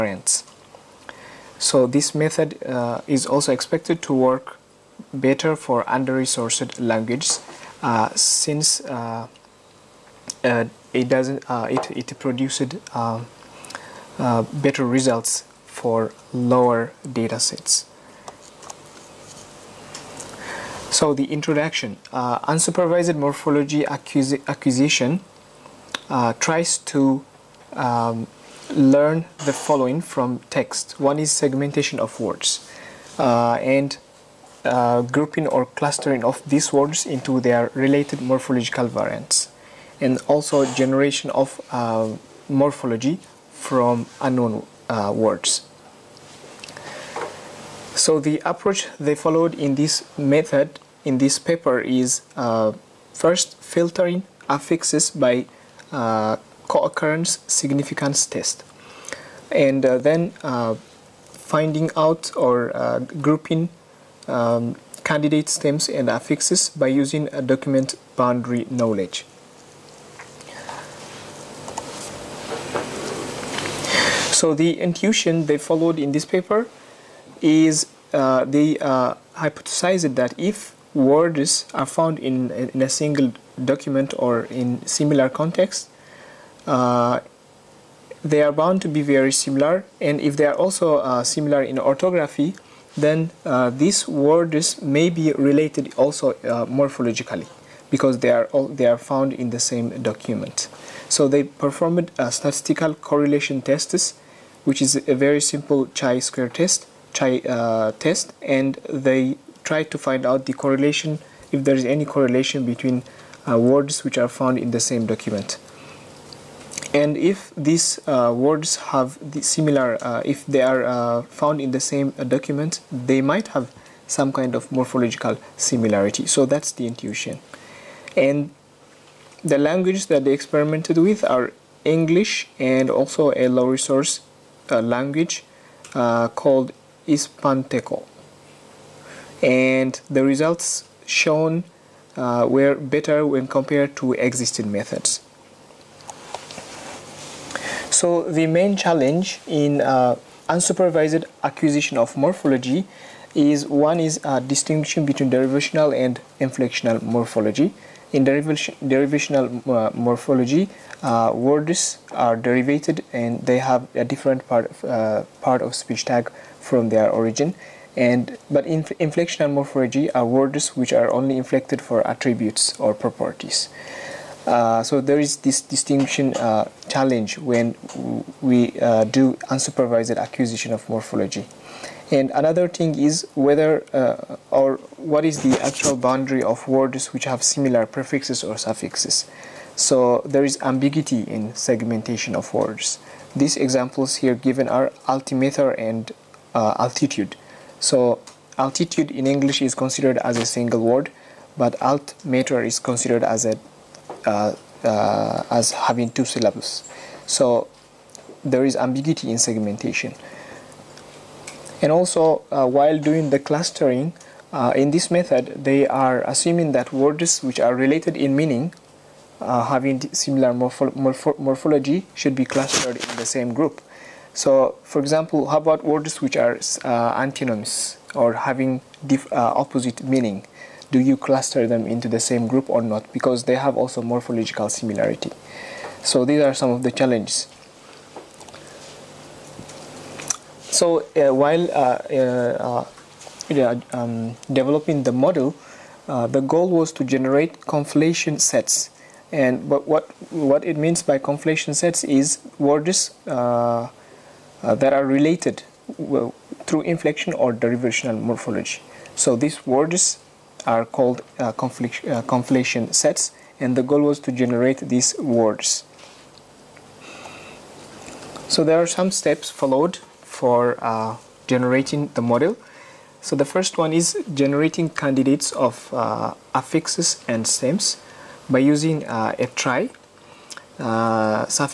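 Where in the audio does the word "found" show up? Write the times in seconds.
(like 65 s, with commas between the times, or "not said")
81 s, 98 s, 114 s, 121 s.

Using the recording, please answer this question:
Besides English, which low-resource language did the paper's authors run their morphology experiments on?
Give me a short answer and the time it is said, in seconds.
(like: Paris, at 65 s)
Ispanteco, at 137 s.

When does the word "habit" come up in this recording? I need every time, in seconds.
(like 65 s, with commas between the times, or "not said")
not said.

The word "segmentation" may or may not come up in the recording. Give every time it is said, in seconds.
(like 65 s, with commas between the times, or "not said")
31 s, 191 s, 209 s.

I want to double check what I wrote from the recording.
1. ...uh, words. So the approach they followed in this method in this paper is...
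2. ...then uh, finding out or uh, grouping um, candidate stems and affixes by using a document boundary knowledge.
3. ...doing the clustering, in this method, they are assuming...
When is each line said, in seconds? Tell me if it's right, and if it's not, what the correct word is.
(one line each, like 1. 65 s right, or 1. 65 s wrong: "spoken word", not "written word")
1. 44 s right
2. 59 s right
3. 212 s right.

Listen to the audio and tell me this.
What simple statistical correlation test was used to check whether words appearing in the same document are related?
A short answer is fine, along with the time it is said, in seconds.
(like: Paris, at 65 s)
chi square test, at 105 s.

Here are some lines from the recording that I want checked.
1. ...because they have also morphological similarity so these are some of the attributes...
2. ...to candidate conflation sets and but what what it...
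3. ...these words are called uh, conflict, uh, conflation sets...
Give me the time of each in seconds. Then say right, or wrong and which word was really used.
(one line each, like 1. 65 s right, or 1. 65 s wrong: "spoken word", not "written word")
1. 233 s wrong: "challenges", not "attributes"
2. 246 s wrong: "generate", not "candidate"
3. 259 s right.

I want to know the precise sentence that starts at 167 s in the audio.
And but in inflectional morphology are words which are only inflected for attributes or properties.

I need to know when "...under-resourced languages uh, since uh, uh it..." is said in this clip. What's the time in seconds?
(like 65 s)
5 s.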